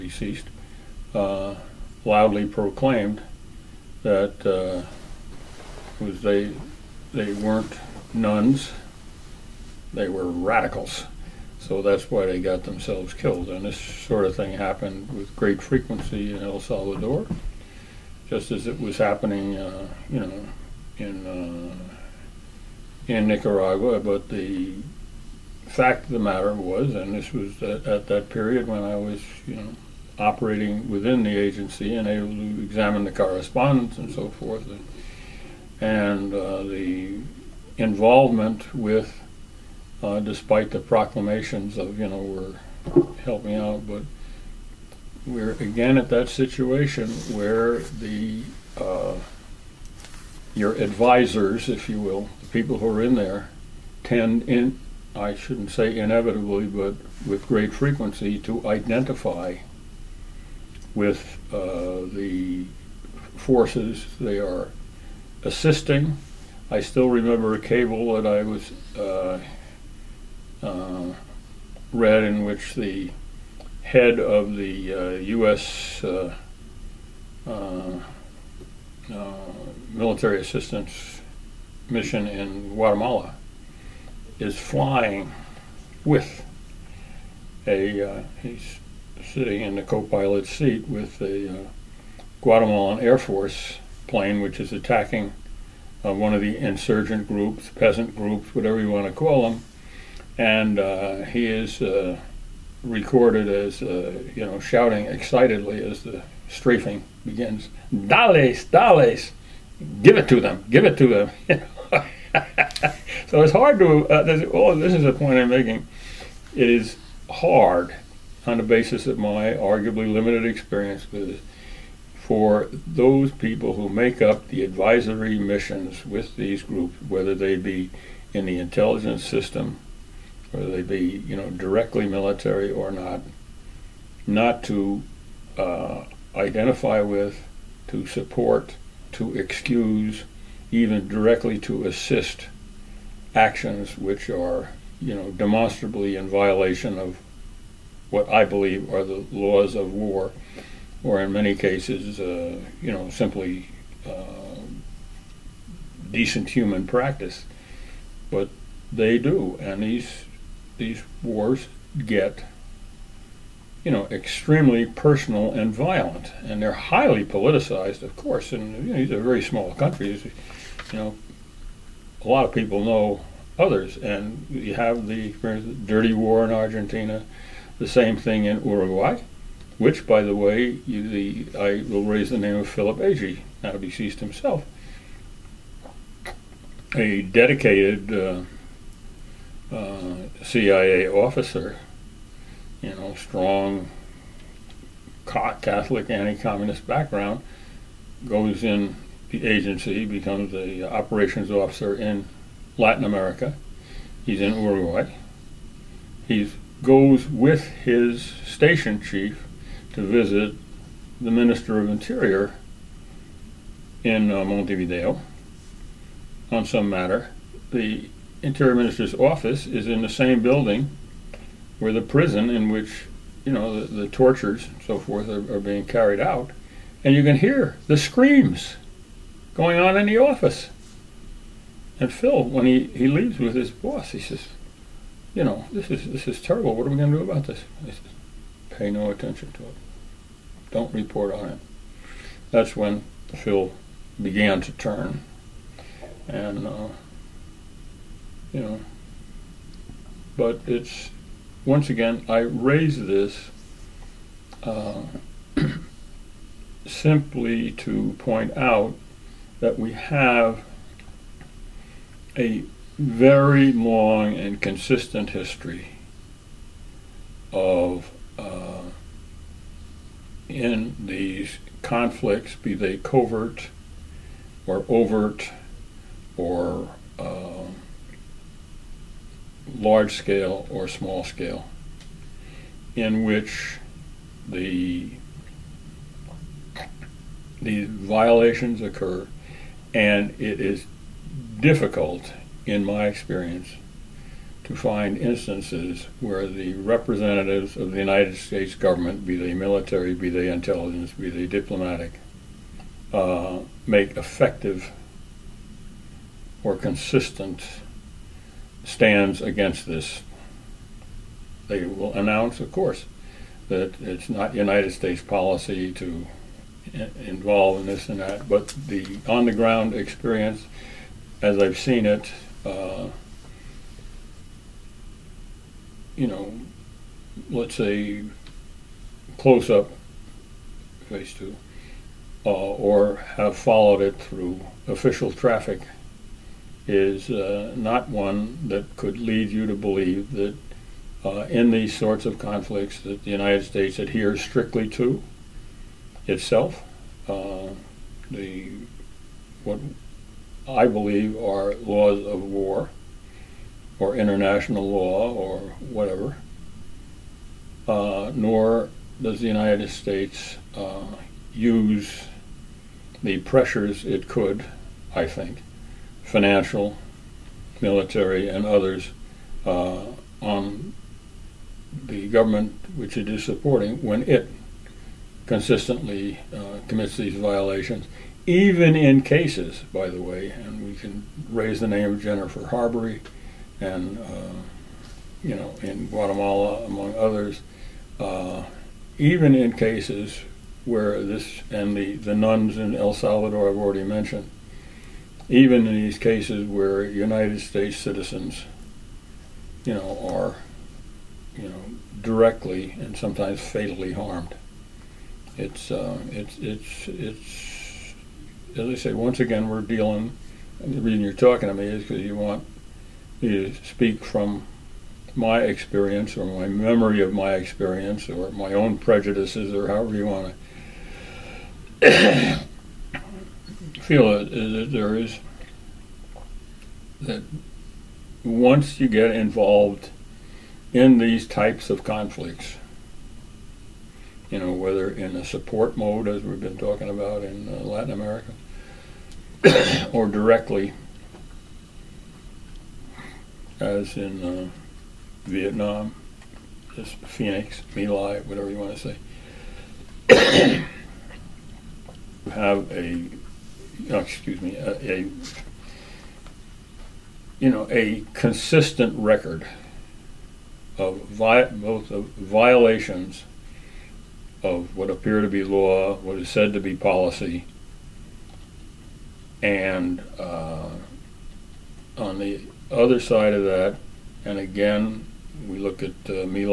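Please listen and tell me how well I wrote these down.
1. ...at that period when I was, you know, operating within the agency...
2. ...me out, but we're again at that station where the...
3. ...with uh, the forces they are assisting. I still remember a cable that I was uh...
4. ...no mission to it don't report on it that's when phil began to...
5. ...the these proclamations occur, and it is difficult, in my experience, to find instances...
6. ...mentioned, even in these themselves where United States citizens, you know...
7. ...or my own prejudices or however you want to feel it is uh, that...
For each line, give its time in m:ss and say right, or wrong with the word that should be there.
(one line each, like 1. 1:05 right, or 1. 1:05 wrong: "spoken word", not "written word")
1. 0:27 right
2. 0:43 wrong: "situation", not "station"
3. 1:00 right
4. 3:58 wrong: "attention", not "mission"
5. 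4:44 wrong: "violations", not "proclamations"
6. 6:34 wrong: "cases", not "themselves"
7. 6:58 right.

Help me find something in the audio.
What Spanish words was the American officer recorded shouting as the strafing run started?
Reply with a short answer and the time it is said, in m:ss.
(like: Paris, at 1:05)
Dales, dales, at 1:48.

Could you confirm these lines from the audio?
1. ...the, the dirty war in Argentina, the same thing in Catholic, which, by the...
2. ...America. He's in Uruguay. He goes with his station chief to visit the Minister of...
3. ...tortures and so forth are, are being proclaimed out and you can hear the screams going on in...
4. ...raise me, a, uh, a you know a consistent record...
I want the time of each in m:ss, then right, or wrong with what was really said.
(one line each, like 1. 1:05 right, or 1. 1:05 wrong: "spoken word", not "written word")
1. 2:55 wrong: "Uruguay", not "Catholic"
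2. 3:23 right
3. 3:44 wrong: "carried", not "proclaimed"
4. 7:34 wrong: "excuse", not "raise".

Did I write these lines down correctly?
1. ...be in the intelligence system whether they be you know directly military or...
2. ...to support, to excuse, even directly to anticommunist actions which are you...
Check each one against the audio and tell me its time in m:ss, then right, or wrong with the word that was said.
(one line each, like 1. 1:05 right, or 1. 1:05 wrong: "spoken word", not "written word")
1. 2:07 right
2. 2:17 wrong: "assist", not "anticommunist".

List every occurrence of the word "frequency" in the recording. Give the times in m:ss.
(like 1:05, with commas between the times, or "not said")
0:15, 0:57.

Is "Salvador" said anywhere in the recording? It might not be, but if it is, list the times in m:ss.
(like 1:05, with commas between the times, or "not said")
0:16, 6:33.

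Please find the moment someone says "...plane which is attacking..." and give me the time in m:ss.
1:34.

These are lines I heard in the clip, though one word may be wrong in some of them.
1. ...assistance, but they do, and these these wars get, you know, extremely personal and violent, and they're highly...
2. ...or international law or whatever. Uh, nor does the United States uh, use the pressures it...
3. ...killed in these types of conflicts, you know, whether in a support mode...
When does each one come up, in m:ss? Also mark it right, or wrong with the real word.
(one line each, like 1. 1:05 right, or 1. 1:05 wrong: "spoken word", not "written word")
1. 2:36 wrong: "practice", not "assistance"
2. 5:54 right
3. 7:09 wrong: "involved", not "killed".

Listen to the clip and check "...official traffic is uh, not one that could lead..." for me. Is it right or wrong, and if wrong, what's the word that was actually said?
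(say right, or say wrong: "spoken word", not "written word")
right.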